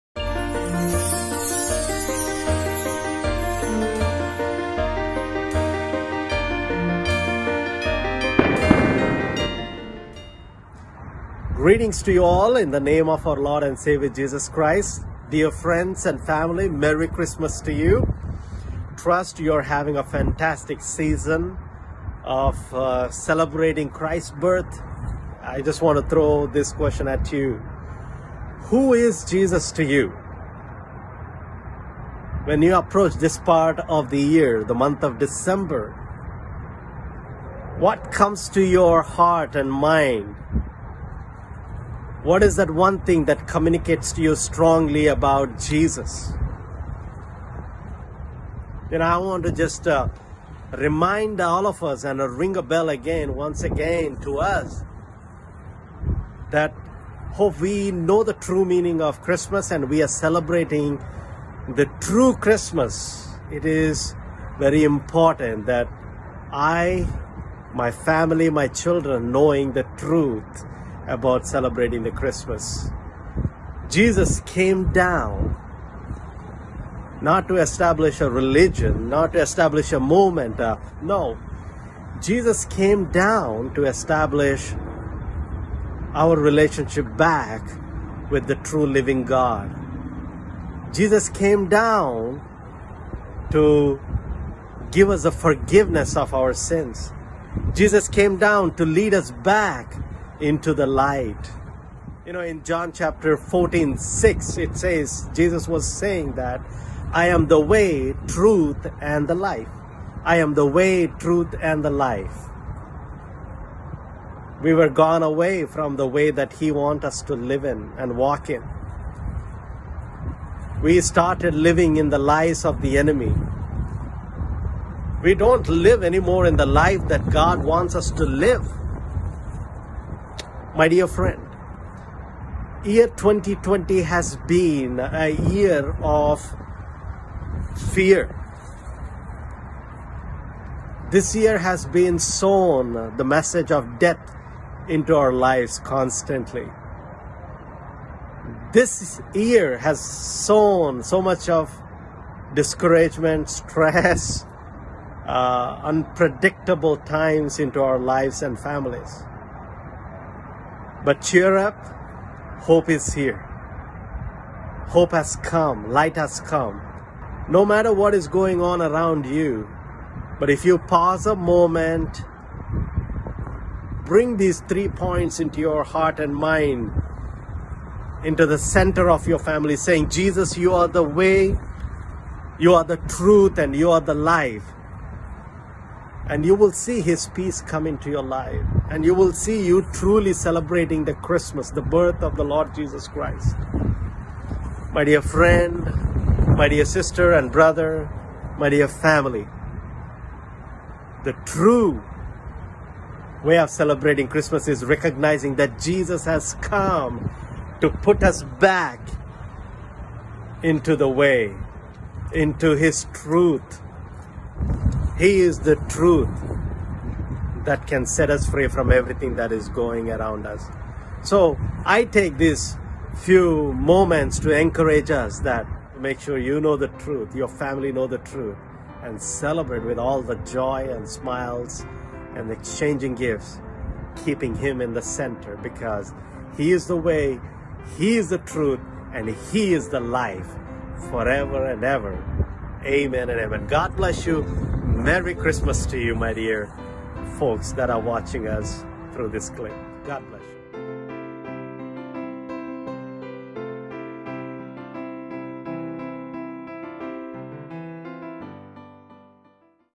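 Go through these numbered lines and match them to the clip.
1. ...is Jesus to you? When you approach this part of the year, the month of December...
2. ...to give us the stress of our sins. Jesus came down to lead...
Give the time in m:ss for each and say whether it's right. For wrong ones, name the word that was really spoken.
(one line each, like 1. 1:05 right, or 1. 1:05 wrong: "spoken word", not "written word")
1. 0:28 right
2. 1:33 wrong: "forgiveness", not "stress".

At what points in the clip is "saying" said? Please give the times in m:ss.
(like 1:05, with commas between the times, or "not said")
1:45, 2:59.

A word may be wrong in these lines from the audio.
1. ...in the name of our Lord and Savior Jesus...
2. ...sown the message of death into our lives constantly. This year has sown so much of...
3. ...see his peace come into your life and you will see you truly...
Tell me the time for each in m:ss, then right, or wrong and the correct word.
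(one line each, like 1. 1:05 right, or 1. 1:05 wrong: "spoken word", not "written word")
1. 0:12 right
2. 2:22 right
3. 3:06 right.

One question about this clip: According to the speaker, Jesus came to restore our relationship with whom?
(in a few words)
the true living God.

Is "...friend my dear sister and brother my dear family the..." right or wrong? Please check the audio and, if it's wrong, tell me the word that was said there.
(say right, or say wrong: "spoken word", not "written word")
right.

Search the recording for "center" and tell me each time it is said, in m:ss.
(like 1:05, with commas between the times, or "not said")
2:58, 3:55.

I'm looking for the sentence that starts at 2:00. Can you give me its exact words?
We started living in the lies of the enemy.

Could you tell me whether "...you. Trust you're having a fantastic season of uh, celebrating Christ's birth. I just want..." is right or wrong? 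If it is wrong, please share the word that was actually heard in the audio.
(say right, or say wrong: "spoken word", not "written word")
right.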